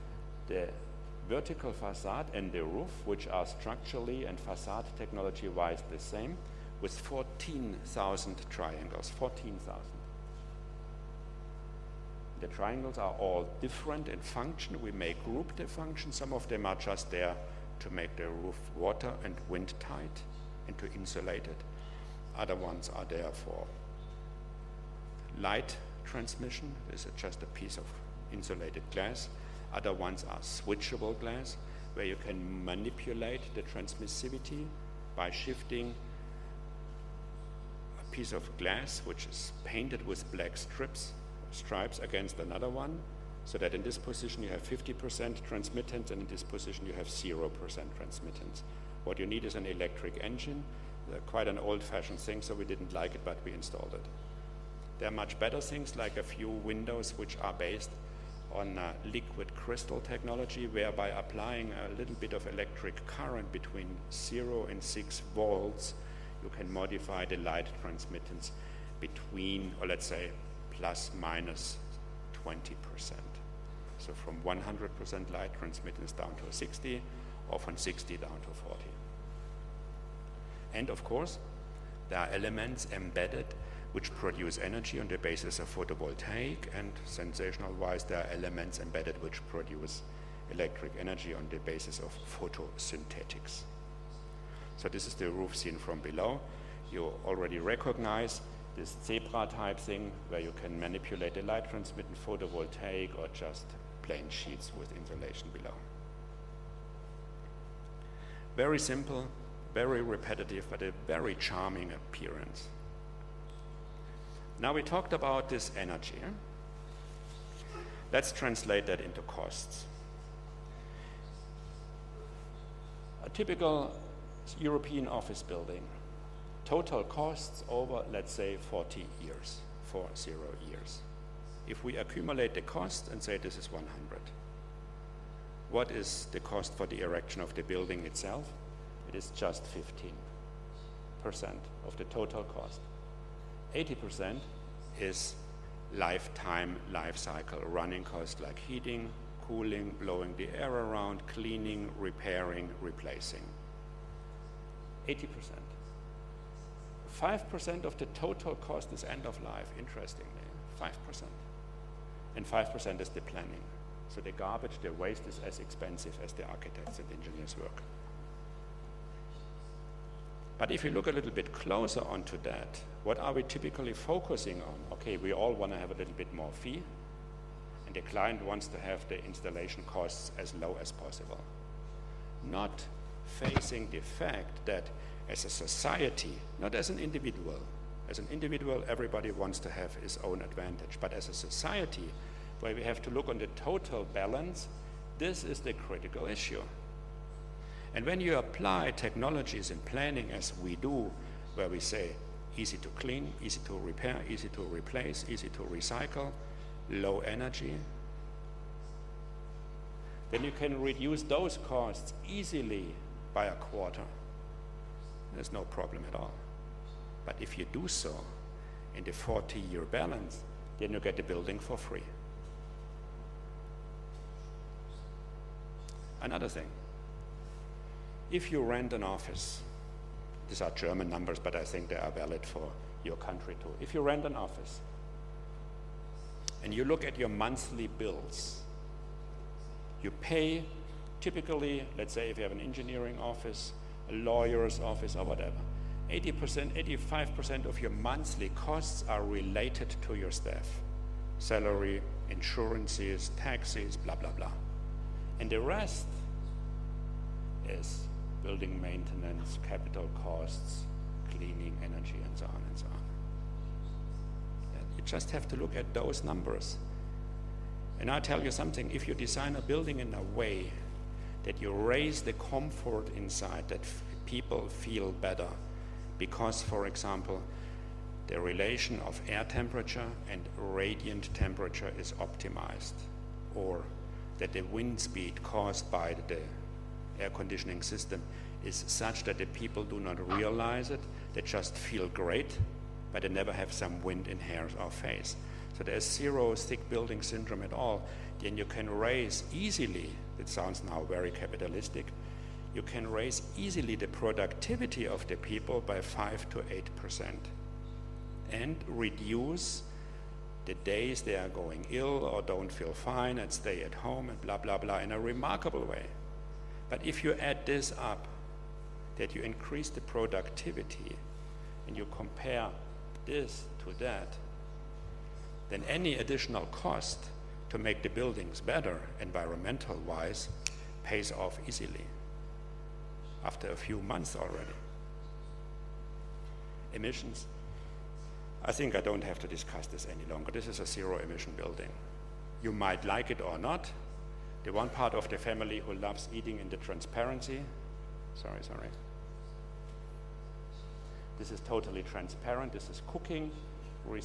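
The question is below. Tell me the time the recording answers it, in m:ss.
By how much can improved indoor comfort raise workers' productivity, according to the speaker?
5:06.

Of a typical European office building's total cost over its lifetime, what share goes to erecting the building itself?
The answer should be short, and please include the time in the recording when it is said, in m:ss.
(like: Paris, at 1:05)
15%, at 2:21.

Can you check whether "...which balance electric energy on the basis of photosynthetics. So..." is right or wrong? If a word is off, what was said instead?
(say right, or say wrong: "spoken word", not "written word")
wrong: "produce", not "balance".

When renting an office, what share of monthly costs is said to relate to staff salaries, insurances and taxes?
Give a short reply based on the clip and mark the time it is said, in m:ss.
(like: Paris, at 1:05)
80-85%, at 4:06.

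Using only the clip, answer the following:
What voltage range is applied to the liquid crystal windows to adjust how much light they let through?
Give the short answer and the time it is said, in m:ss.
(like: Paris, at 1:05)
0 to 6 volts, at 1:03.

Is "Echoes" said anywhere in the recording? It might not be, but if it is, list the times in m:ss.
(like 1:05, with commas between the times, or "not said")
not said.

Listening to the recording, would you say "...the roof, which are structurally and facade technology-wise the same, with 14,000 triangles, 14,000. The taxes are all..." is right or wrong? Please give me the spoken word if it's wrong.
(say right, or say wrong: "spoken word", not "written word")
wrong: "triangles", not "taxes".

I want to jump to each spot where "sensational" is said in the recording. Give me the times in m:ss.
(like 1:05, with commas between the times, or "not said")
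1:27.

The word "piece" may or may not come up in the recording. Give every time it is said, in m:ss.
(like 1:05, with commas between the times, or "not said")
0:27, 0:38.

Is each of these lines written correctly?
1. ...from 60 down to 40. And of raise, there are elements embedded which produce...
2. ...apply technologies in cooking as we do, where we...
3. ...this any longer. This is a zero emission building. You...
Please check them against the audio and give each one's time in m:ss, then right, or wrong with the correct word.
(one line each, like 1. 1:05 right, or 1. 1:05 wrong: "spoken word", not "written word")
1. 1:17 wrong: "course", not "raise"
2. 3:18 wrong: "planning", not "cooking"
3. 5:39 right.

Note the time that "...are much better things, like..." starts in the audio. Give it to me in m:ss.
0:55.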